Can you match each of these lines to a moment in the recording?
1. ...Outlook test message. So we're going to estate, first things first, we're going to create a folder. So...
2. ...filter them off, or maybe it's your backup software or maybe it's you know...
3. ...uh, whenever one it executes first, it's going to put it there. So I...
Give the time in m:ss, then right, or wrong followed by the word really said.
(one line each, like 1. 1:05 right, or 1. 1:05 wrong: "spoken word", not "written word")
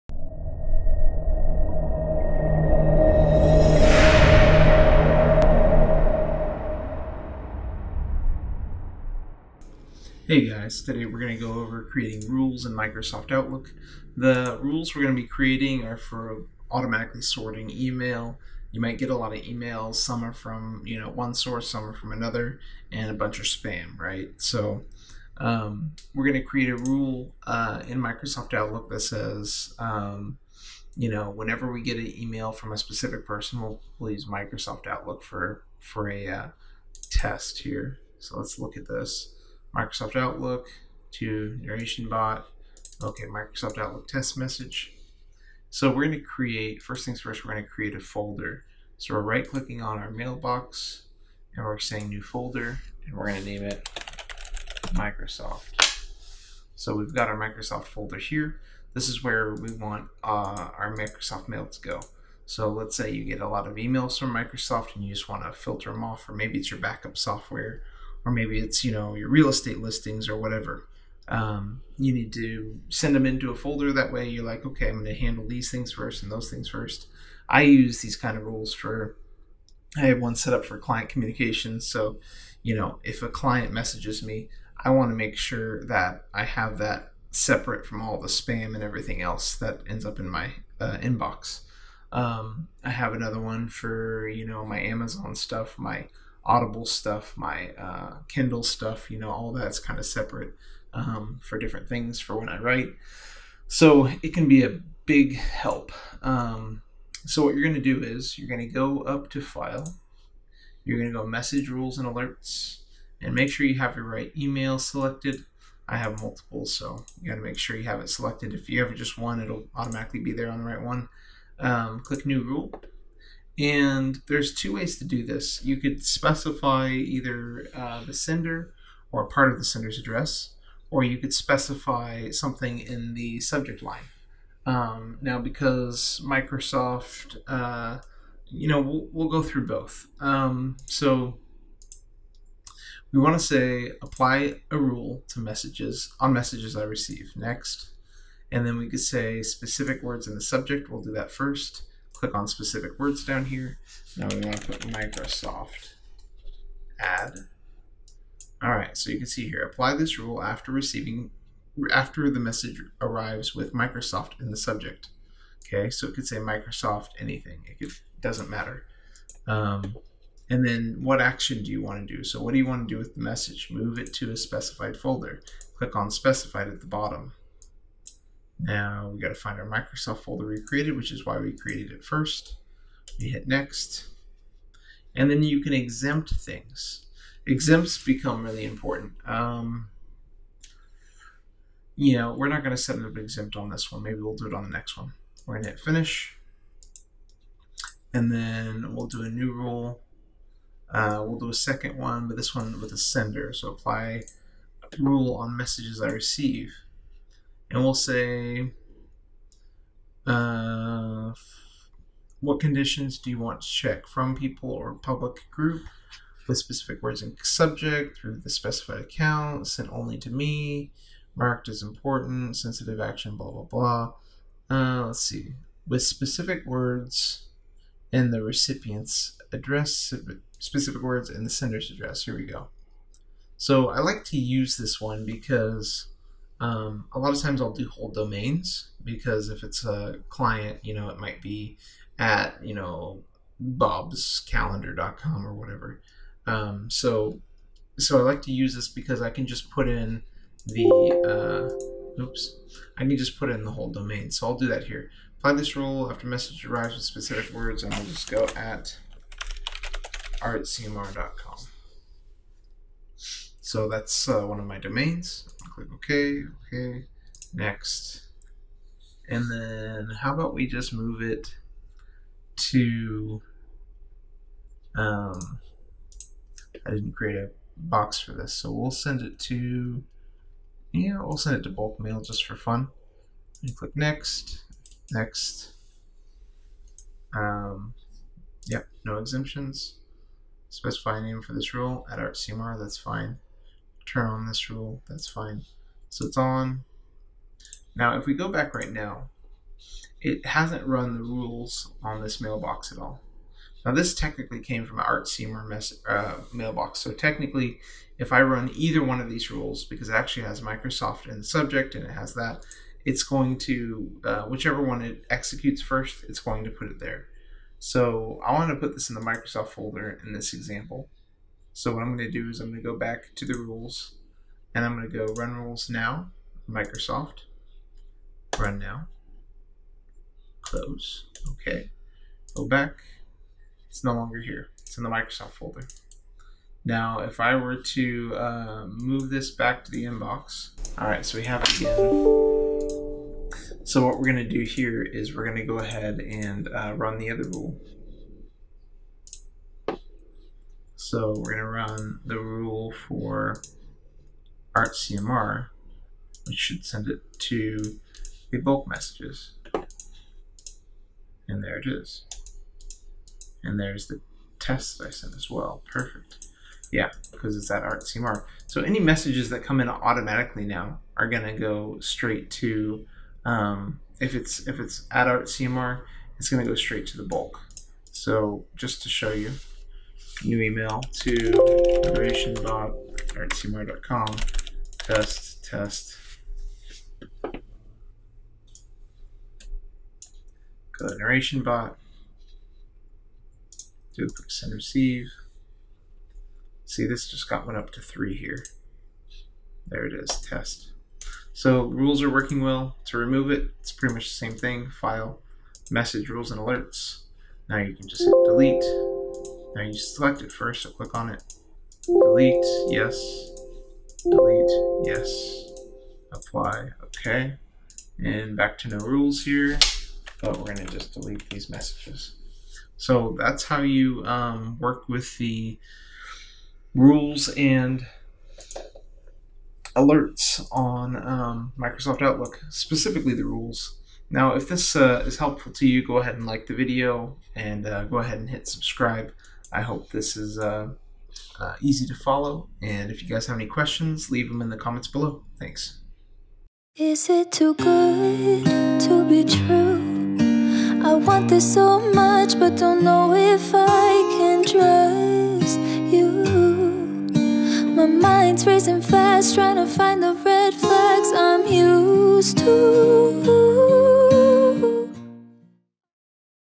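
1. 0:43 wrong: "create", not "estate"
2. 1:05 right
3. 5:14 wrong: "whichever", not "whenever".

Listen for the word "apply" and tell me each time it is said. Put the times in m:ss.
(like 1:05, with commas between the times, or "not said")
2:24, 2:39, 3:23, 4:15, 6:56.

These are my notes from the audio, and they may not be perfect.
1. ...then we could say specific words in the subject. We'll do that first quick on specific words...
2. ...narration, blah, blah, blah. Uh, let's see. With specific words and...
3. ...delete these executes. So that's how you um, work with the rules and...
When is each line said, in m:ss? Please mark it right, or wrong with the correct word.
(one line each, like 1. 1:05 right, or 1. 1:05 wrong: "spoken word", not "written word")
1. 2:28 wrong: "click", not "quick"
2. 3:42 wrong: "action", not "narration"
3. 7:01 wrong: "messages", not "executes".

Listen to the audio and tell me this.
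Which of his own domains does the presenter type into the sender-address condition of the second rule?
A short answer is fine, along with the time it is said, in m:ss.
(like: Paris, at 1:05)
artcmr.com, at 4:20.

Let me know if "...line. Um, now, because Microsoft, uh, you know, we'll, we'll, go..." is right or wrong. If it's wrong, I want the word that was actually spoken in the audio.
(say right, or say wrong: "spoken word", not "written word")
right.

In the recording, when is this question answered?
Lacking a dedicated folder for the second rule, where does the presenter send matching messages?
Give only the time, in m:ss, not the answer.
4:41.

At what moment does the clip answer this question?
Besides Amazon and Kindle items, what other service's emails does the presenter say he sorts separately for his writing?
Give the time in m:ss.
1:35.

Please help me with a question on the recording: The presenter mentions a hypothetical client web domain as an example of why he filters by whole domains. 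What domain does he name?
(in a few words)
bobscalendar.com.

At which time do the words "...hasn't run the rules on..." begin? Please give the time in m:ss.
5:00.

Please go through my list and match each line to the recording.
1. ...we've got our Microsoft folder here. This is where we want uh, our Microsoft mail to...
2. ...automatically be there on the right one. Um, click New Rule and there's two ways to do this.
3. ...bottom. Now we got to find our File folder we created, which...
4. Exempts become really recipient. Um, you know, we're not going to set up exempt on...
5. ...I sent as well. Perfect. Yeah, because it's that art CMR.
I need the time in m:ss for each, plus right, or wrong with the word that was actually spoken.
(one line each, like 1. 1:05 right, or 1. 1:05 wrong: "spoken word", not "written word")
1. 0:56 right
2. 1:59 right
3. 2:56 wrong: "Microsoft", not "File"
4. 3:07 wrong: "important", not "recipient"
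5. 6:05 right.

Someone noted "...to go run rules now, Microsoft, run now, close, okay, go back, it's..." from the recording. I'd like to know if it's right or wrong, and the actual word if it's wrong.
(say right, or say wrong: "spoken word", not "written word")
right.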